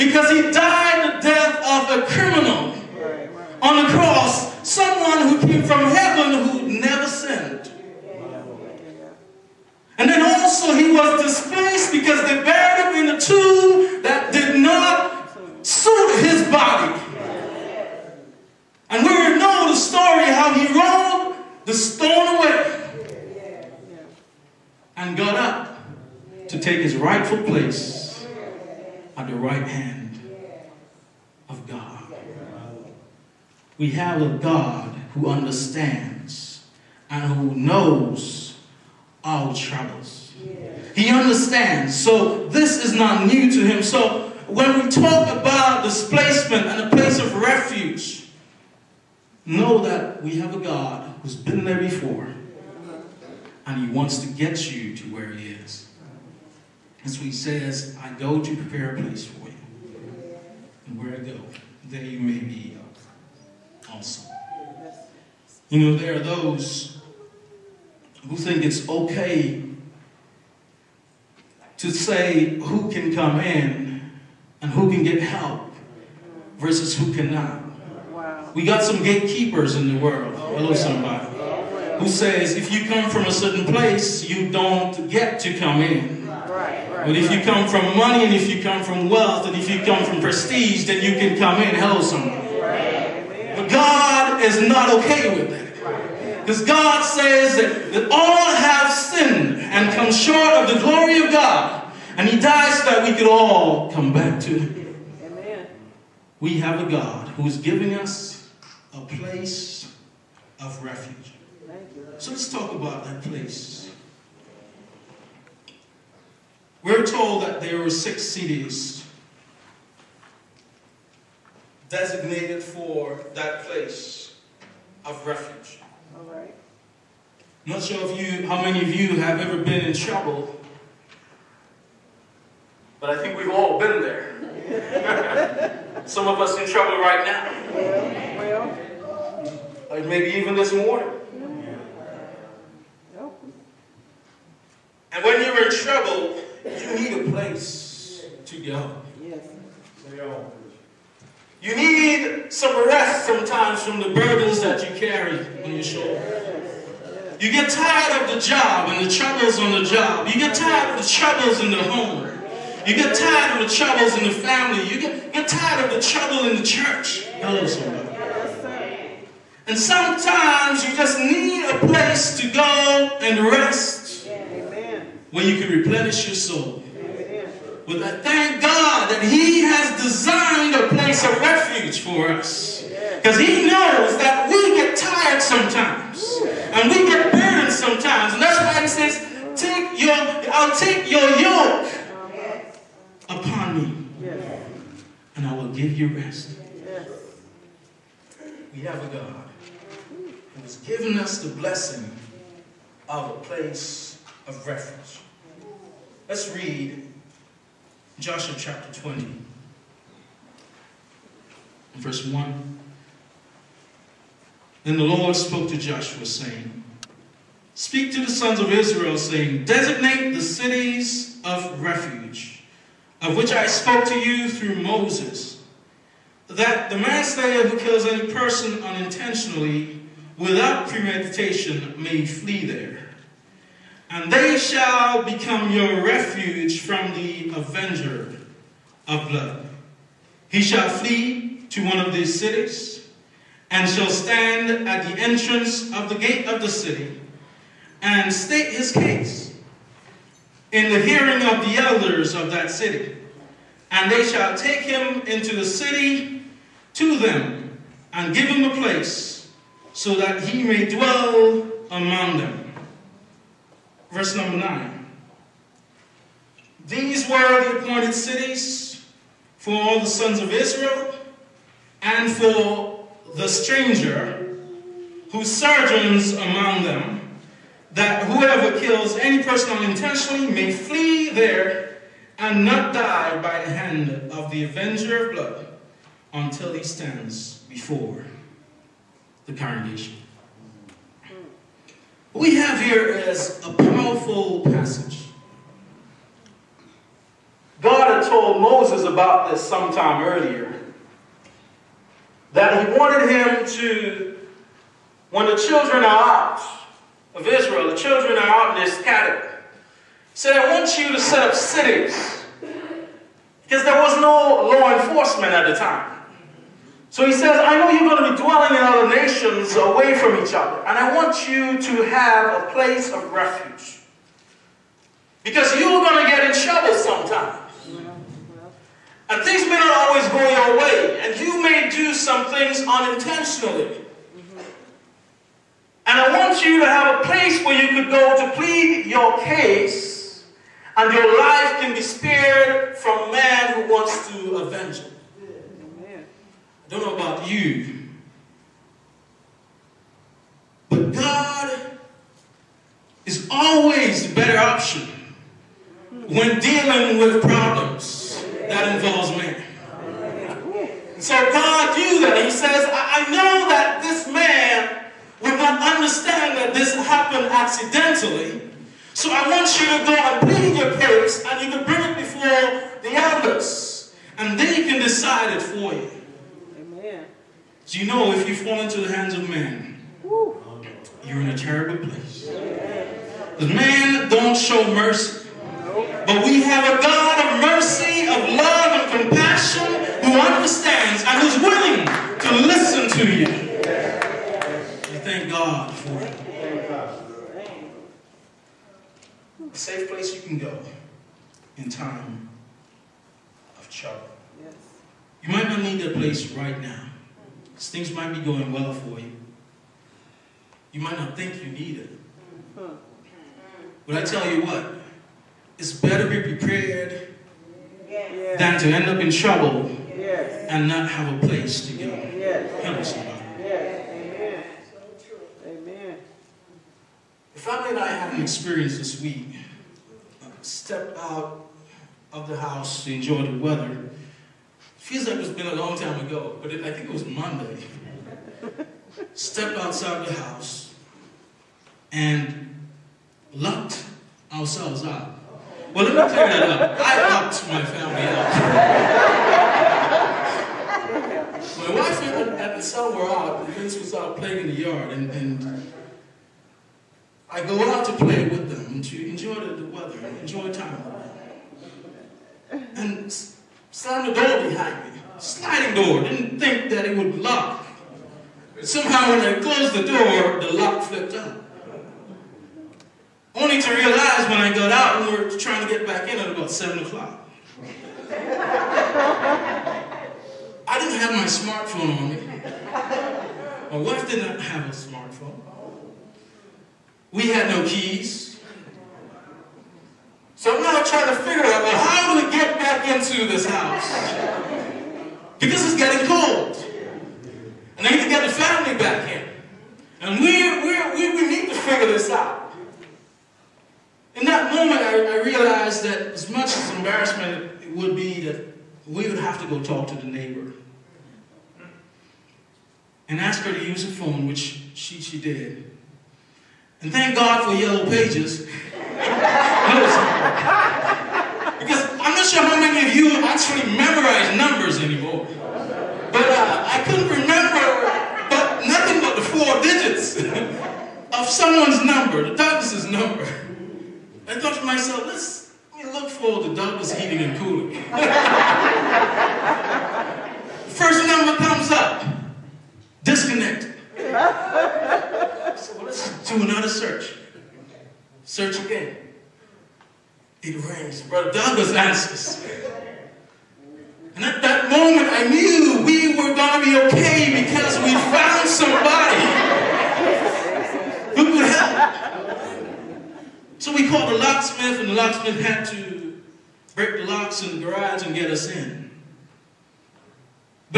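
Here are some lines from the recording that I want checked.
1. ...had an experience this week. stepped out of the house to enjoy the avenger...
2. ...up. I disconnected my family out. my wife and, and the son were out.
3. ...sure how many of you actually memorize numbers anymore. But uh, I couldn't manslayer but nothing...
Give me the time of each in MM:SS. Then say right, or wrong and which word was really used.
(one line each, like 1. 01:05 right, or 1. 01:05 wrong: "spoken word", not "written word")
1. 07:08 wrong: "weather", not "avenger"
2. 07:26 wrong: "locked", not "disconnected"
3. 08:42 wrong: "remember", not "manslayer".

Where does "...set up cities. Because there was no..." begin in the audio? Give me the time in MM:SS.
05:11.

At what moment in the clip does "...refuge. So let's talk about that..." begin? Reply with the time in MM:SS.
01:50.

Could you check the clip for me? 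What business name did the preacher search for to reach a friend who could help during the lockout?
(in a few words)
Douglas heating and cooling.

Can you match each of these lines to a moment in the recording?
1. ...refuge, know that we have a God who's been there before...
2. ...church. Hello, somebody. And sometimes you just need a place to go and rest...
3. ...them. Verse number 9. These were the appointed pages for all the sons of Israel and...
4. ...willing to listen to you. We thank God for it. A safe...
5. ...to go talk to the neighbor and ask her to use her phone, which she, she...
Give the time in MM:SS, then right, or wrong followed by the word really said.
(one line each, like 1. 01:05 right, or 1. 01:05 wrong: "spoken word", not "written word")
1. 00:47 right
2. 02:46 right
3. 04:22 wrong: "cities", not "pages"
4. 06:31 right
5. 08:29 right.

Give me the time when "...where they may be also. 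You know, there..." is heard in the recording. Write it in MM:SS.
01:00.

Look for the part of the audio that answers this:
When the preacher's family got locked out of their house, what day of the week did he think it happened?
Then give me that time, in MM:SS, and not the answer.
07:17.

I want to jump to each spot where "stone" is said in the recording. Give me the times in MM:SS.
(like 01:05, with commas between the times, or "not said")
00:21.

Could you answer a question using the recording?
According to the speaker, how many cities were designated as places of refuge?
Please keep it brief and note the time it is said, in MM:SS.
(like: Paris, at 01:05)
6, at 01:57.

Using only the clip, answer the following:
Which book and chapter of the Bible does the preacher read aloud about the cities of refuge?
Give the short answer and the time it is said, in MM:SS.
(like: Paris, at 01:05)
Joshua chapter 20, at 03:28.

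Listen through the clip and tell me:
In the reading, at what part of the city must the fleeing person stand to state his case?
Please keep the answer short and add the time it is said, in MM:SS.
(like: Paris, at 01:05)
the entrance of the gate, at 04:05.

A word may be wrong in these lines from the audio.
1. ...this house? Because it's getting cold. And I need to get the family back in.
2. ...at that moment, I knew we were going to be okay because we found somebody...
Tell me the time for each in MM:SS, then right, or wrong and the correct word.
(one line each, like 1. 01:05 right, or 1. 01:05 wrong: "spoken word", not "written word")
1. 08:13 right
2. 09:14 right.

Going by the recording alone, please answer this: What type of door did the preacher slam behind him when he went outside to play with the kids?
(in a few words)
Sliding door.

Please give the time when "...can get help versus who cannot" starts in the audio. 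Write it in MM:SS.
01:14.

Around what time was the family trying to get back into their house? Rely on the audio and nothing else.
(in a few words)
7 o'clock.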